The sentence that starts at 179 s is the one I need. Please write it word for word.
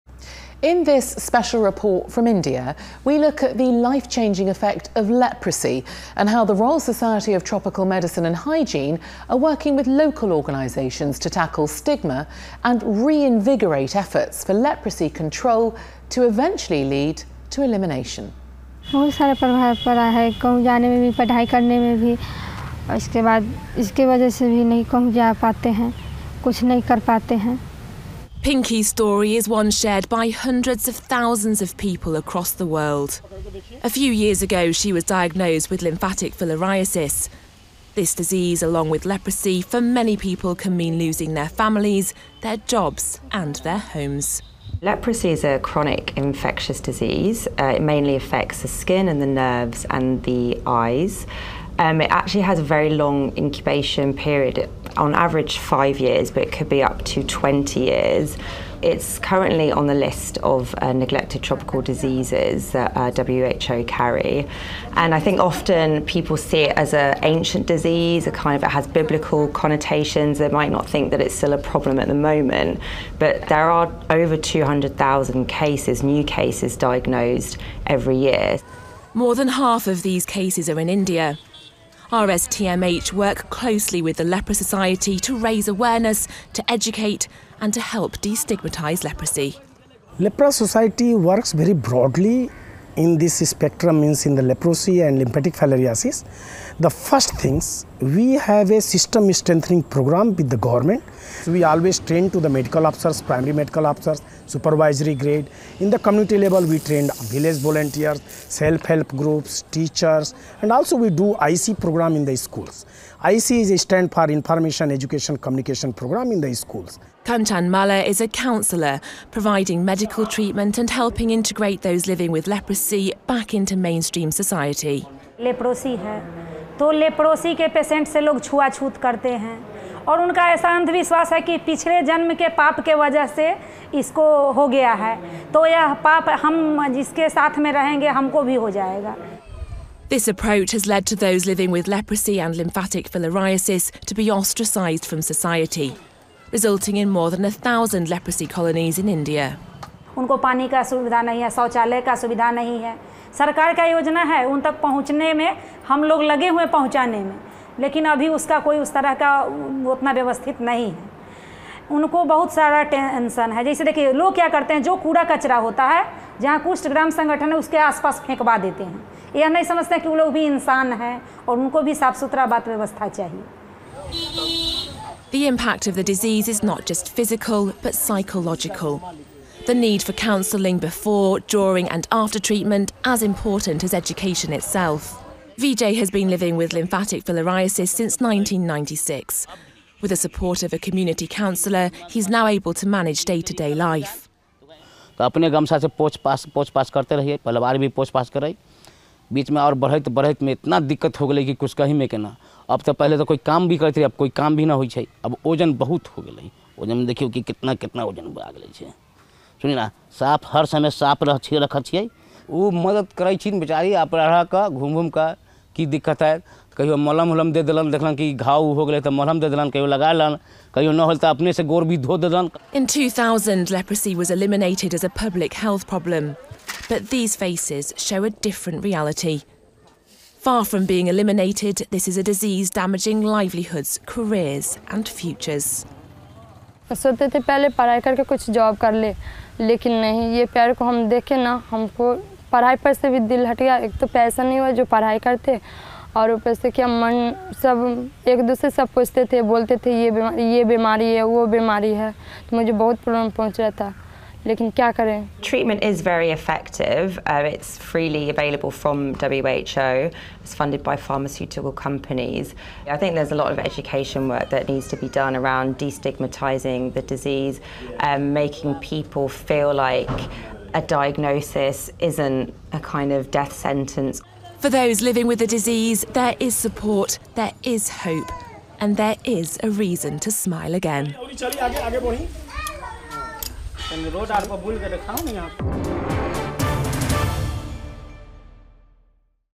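The need for counselling before, during and after treatment as important as education itself.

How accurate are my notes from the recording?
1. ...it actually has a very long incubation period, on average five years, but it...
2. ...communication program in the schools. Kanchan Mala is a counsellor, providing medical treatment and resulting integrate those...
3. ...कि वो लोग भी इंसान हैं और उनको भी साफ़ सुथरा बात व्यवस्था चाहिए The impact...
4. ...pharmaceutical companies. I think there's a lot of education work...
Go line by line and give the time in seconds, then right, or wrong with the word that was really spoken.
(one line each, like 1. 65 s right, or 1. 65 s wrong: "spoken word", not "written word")
1. 51 s right
2. 115 s wrong: "helping", not "resulting"
3. 169 s right
4. 260 s right.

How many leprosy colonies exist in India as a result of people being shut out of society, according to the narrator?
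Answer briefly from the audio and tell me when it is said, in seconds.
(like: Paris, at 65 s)
more than a thousand, at 147 s.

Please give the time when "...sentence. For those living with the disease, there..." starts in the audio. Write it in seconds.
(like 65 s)
273 s.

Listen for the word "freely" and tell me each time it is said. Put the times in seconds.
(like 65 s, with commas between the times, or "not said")
257 s.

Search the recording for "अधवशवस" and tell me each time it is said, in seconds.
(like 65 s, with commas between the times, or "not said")
130 s.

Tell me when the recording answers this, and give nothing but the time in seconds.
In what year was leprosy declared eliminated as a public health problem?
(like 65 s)
222 s.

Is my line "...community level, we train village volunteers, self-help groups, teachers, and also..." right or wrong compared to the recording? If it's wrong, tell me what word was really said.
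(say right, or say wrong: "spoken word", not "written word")
right.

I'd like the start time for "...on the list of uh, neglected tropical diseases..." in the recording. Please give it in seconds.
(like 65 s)
59 s.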